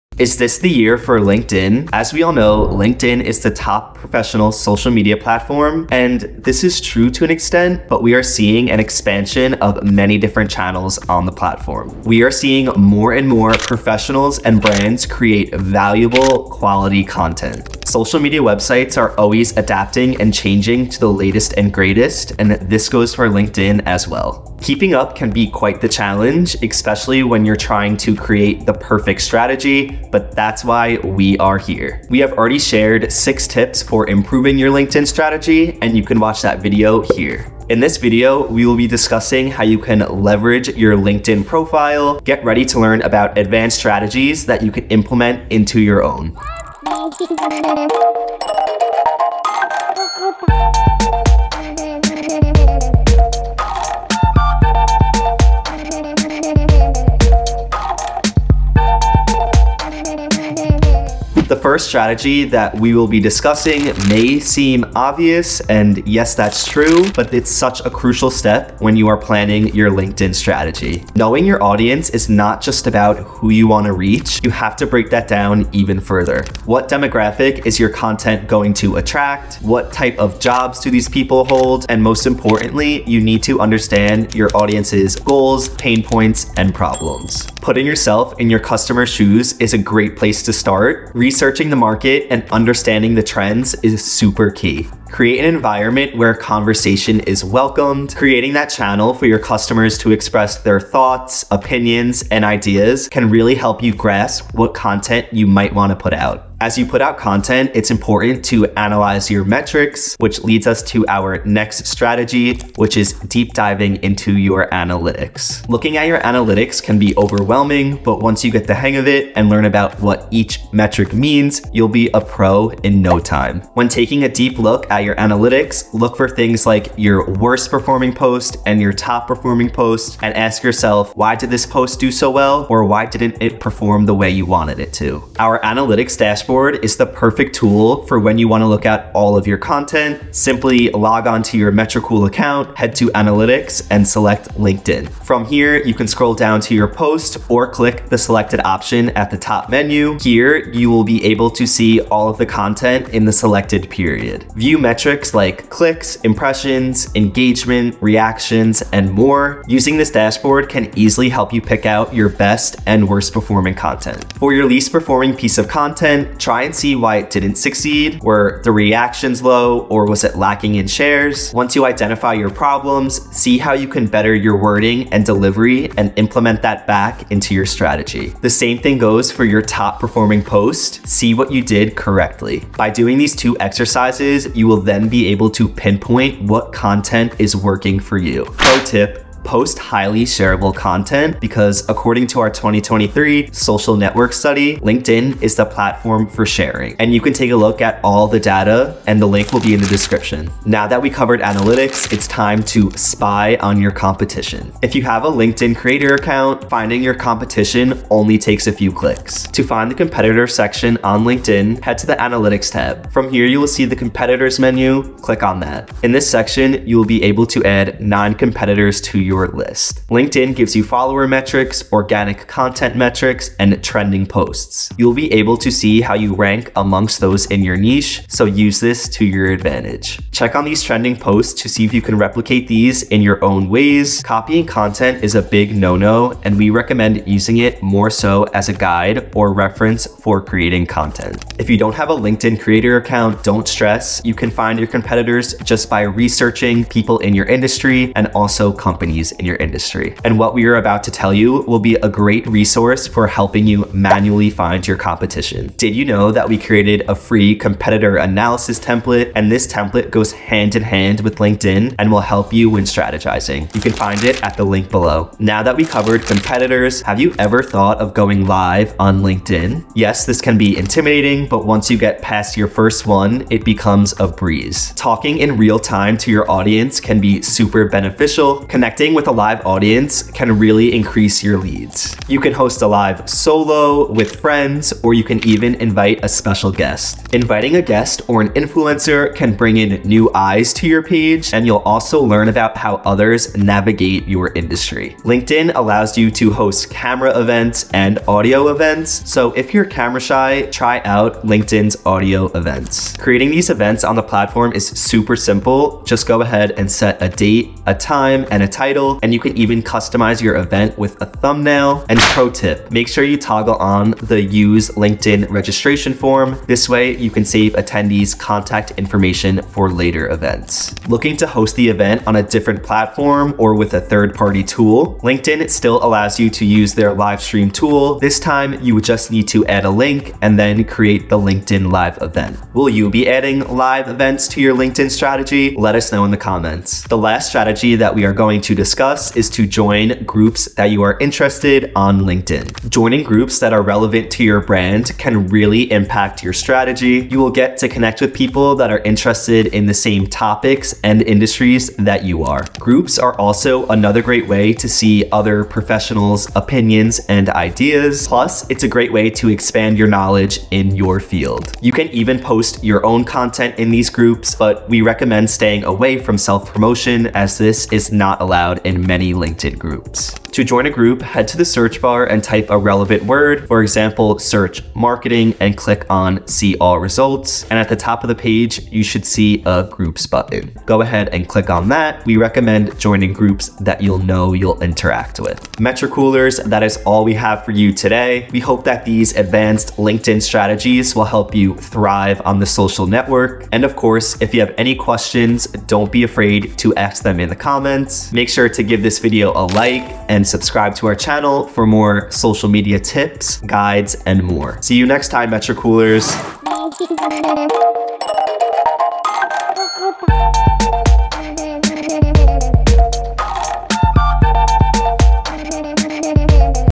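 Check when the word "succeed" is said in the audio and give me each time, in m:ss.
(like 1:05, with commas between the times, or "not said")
2:47.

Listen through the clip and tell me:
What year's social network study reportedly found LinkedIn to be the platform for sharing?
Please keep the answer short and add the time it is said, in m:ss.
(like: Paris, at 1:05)
2023, at 3:12.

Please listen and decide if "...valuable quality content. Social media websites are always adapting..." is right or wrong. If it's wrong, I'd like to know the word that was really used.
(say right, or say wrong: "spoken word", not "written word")
right.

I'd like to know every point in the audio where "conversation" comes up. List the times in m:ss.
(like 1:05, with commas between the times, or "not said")
1:36.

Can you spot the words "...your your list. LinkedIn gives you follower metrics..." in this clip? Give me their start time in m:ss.
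3:39.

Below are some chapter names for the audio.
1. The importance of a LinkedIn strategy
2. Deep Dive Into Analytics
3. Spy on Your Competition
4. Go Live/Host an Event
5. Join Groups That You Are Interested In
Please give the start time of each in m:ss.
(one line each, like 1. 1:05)
1. 1:02
2. 1:52
3. 3:22
4. 4:28
5. 5:39.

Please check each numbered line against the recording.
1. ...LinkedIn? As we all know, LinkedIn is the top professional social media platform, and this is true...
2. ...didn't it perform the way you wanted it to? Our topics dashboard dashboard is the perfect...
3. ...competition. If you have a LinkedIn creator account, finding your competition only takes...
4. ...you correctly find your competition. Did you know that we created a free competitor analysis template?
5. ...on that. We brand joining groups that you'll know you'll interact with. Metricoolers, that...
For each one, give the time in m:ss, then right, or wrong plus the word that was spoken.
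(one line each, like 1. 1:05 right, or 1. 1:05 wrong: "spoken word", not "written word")
1. 0:01 right
2. 2:13 wrong: "analytics", not "topics"
3. 3:23 right
4. 4:13 wrong: "manually", not "correctly"
5. 6:21 wrong: "recommend", not "brand".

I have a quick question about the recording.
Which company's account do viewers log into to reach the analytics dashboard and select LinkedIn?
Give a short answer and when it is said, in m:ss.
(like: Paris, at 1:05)
Metricool, at 2:21.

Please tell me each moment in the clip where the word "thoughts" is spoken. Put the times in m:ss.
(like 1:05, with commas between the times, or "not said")
1:40, 4:27.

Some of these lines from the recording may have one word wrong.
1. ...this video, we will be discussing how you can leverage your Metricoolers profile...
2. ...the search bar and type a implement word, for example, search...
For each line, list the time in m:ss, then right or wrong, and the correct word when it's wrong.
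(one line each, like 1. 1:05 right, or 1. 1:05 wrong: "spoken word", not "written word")
1. 0:37 wrong: "LinkedIn", not "Metricoolers"
2. 6:11 wrong: "relevant", not "implement".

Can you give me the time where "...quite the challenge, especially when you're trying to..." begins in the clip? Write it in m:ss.
0:25.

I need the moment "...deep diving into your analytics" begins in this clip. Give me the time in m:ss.
1:53.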